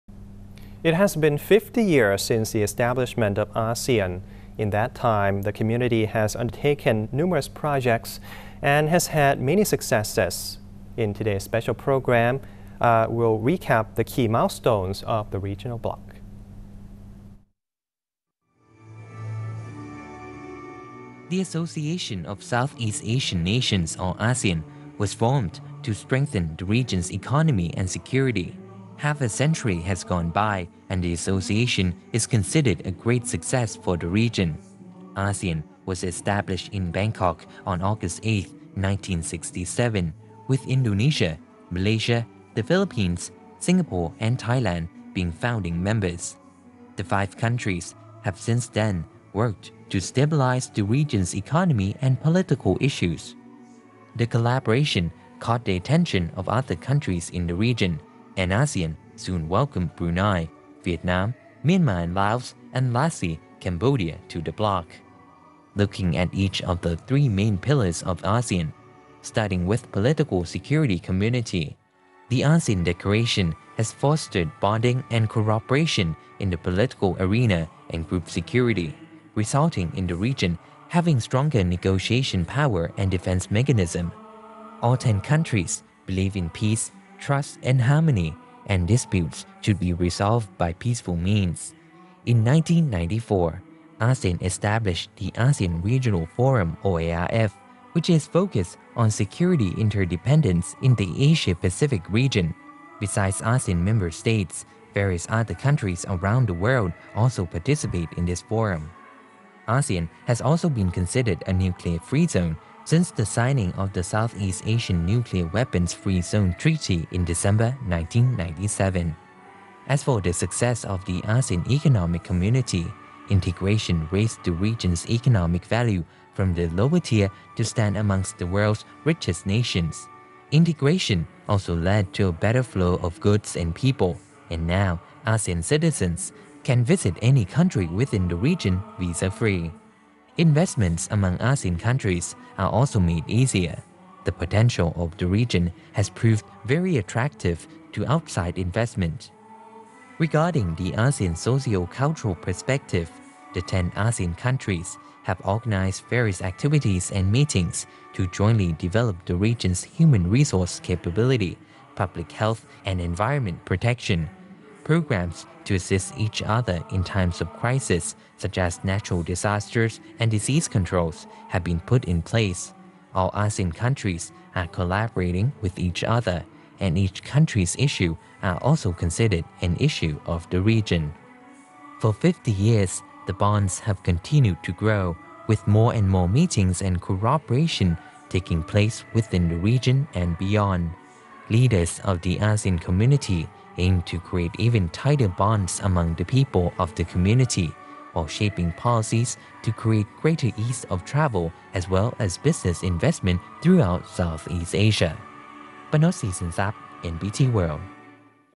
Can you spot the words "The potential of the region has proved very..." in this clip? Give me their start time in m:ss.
2:24.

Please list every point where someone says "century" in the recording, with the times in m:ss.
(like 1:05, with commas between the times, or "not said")
0:29.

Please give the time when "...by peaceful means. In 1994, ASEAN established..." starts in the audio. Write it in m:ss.
1:30.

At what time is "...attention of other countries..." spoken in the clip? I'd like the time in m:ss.
0:55.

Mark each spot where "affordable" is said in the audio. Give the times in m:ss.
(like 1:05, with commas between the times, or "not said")
not said.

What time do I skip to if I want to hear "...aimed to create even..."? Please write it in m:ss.
3:13.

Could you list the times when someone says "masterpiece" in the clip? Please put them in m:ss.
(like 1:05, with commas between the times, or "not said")
not said.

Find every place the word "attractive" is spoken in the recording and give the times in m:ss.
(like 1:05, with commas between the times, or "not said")
2:26.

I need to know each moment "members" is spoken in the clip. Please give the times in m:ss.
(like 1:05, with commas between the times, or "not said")
0:45, 1:43.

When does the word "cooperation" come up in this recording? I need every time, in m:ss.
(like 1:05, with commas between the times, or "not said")
1:15, 3:06.